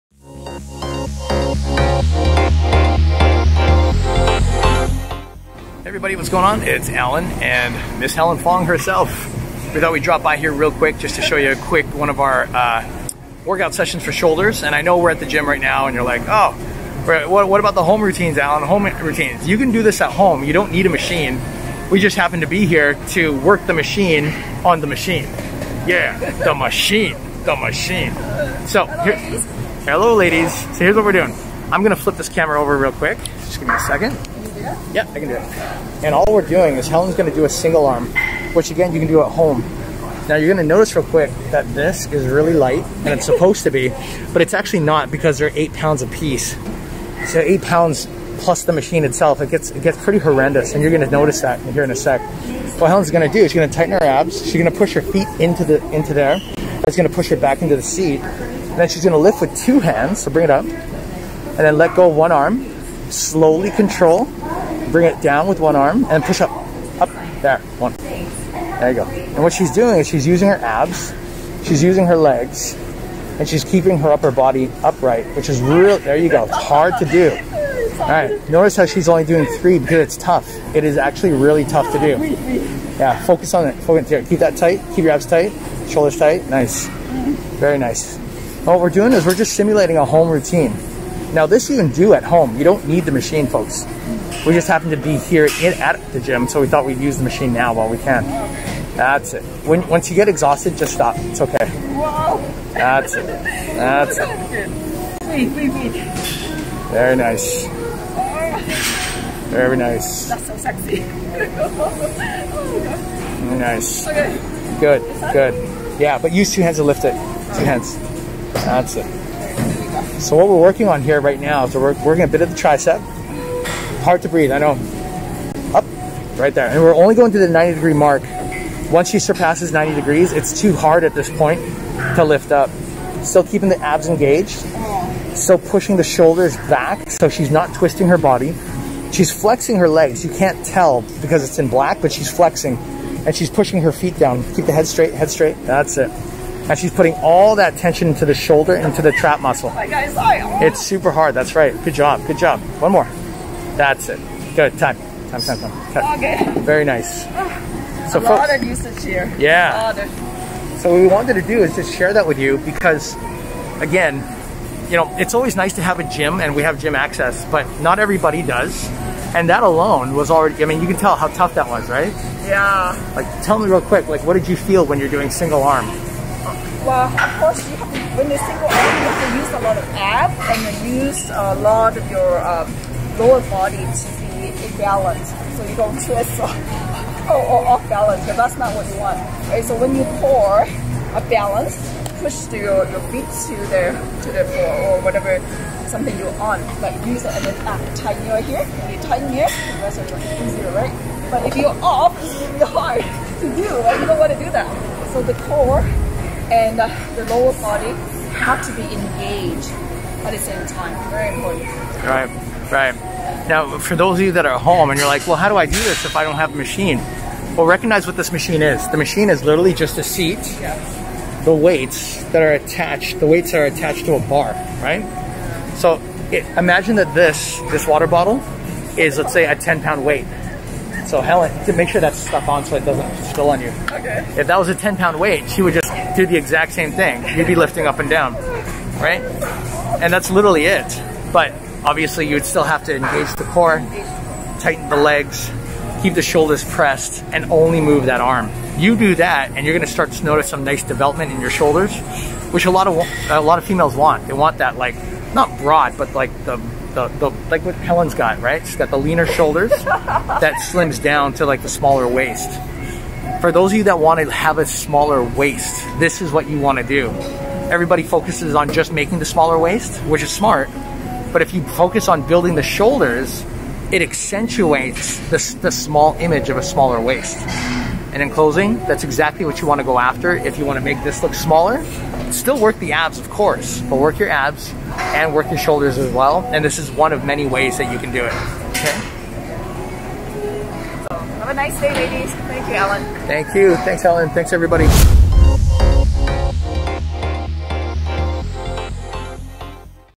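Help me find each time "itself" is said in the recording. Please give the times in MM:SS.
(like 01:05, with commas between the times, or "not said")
00:49.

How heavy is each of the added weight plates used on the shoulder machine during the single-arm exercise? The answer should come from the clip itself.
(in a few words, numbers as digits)
8 pounds.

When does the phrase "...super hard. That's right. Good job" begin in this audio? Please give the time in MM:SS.
02:30.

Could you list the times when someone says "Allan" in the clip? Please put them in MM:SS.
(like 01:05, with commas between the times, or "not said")
00:06, 00:18.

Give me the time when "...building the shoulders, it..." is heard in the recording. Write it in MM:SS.
04:32.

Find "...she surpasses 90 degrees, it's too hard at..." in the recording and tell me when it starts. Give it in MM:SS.
02:09.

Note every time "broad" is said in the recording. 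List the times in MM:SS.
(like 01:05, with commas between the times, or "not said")
04:15.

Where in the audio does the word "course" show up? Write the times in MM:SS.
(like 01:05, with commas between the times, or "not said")
02:57, 04:43.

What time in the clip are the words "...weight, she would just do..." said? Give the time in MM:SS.
03:55.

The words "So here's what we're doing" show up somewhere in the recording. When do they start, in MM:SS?
00:30.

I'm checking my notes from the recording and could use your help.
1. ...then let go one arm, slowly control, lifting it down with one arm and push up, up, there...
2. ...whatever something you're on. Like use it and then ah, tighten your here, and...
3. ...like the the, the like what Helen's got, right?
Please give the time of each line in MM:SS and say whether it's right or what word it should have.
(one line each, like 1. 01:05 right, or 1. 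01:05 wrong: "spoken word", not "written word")
1. 01:01 wrong: "bring", not "lifting"
2. 03:15 right
3. 04:16 right.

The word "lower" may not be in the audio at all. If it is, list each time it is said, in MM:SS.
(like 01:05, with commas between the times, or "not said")
03:03, 03:27.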